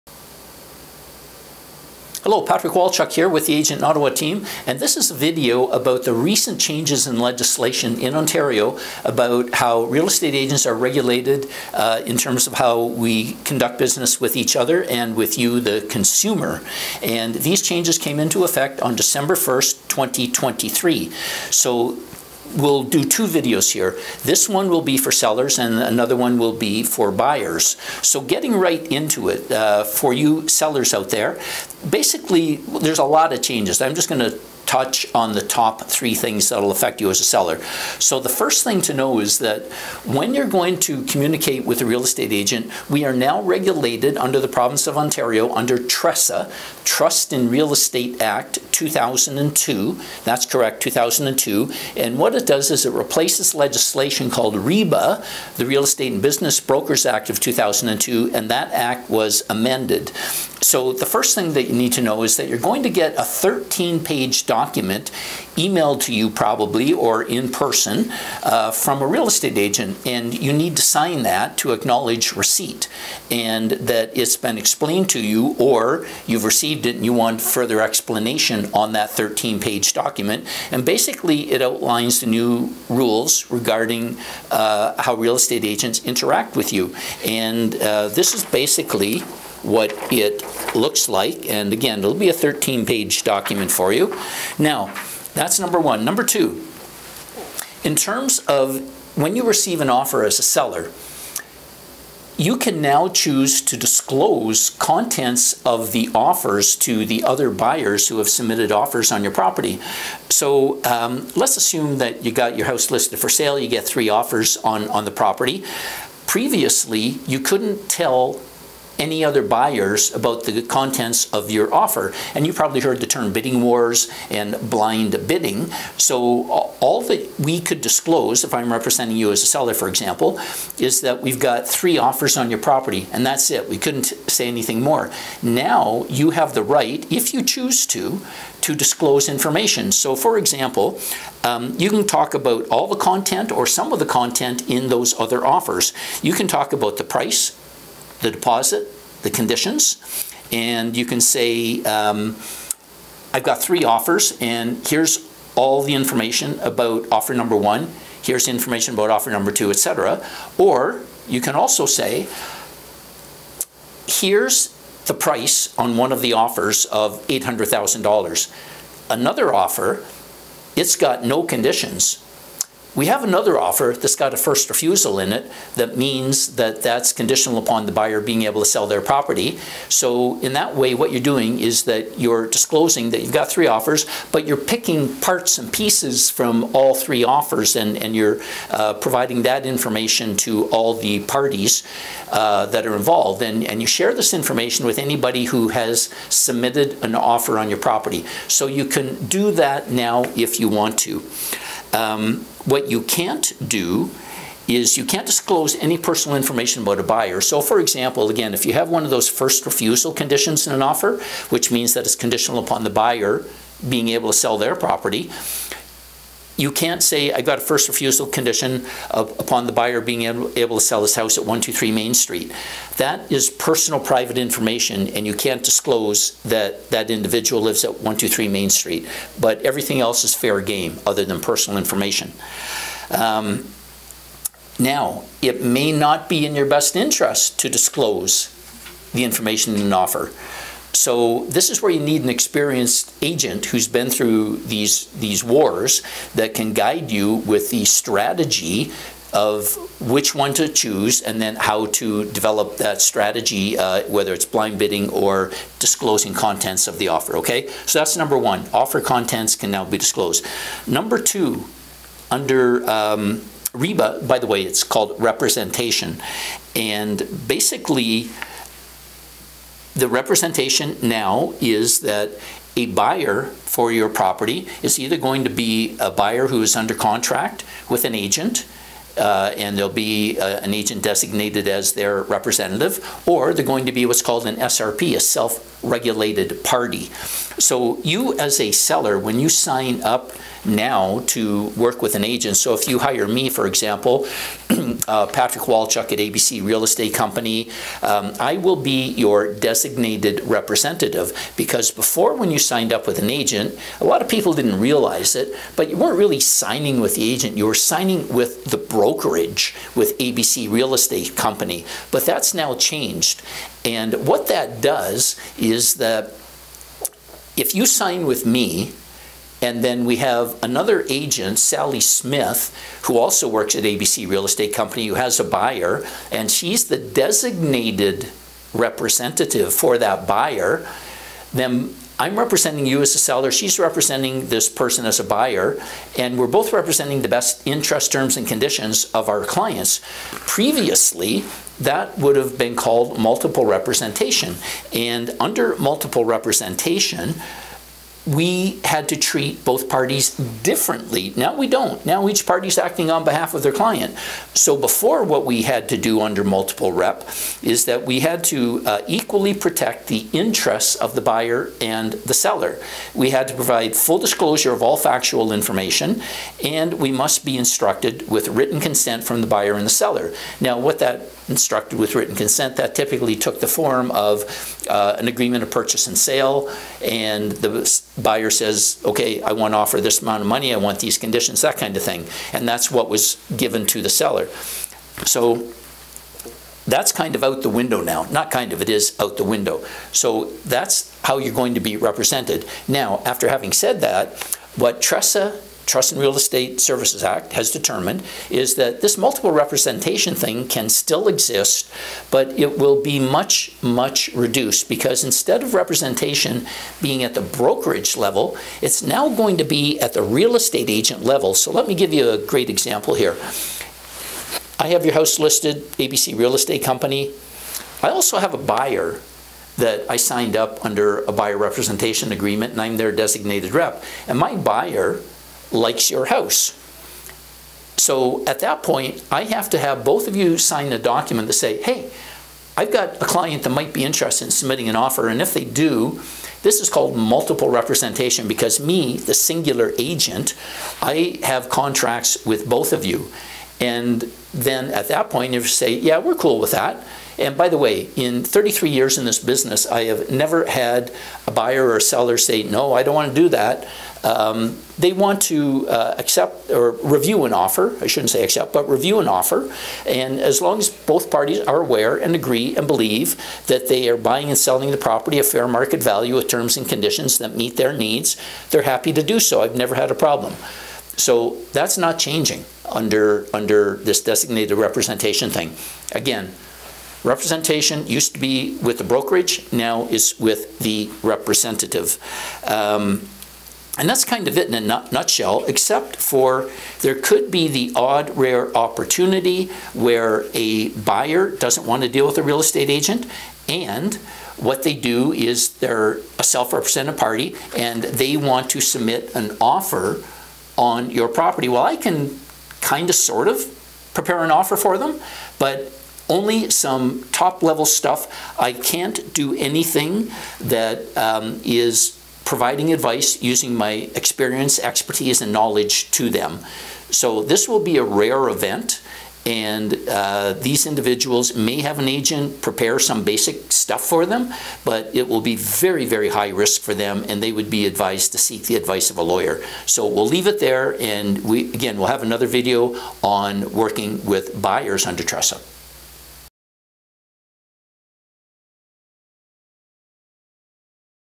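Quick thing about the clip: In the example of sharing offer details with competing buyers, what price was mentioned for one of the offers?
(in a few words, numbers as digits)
$800,000.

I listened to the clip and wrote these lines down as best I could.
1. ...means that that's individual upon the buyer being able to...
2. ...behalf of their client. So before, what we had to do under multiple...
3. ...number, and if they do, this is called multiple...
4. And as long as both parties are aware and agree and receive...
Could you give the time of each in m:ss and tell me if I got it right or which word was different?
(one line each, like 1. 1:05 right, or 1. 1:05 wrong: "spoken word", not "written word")
1. 2:55 wrong: "conditional", not "individual"
2. 5:53 right
3. 7:14 wrong: "offer", not "number"
4. 7:40 wrong: "believe", not "receive".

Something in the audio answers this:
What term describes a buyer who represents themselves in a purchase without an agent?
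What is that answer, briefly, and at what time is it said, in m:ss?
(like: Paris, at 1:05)
self regulated party, at 4:45.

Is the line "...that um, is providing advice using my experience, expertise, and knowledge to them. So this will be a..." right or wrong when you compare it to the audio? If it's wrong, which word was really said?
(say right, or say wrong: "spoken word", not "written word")
right.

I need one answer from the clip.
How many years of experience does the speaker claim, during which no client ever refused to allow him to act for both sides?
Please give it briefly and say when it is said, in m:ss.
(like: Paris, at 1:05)
33, at 7:28.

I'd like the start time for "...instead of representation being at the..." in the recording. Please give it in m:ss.
6:45.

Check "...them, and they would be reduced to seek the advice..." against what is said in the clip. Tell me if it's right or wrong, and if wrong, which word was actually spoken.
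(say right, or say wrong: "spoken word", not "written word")
wrong: "advised", not "reduced".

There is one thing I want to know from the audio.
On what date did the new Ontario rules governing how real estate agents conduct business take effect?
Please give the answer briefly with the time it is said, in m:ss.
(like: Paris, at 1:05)
December 1st, 2023, at 0:18.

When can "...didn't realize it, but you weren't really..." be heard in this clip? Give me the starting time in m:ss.
5:04.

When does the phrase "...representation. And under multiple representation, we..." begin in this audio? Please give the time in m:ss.
5:43.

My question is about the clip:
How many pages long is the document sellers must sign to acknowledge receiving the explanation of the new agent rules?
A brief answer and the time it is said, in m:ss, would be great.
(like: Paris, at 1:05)
13, at 1:03.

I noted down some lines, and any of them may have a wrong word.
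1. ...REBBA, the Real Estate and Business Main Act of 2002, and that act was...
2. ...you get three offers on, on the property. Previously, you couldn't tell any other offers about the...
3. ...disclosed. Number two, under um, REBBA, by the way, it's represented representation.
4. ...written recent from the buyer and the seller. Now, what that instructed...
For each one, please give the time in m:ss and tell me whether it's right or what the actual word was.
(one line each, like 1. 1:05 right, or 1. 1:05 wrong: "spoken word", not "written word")
1. 0:54 wrong: "Brokers", not "Main"
2. 1:53 wrong: "buyers", not "offers"
3. 4:19 wrong: "called", not "represented"
4. 6:08 wrong: "consent", not "recent".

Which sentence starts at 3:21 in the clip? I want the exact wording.
Um, what you can't do is you can't disclose any personal information about a buyer.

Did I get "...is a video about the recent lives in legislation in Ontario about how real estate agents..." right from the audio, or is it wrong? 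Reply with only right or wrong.
wrong.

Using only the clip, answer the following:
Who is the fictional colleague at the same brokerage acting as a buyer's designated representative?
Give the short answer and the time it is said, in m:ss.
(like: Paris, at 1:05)
Sally Smith, at 5:21.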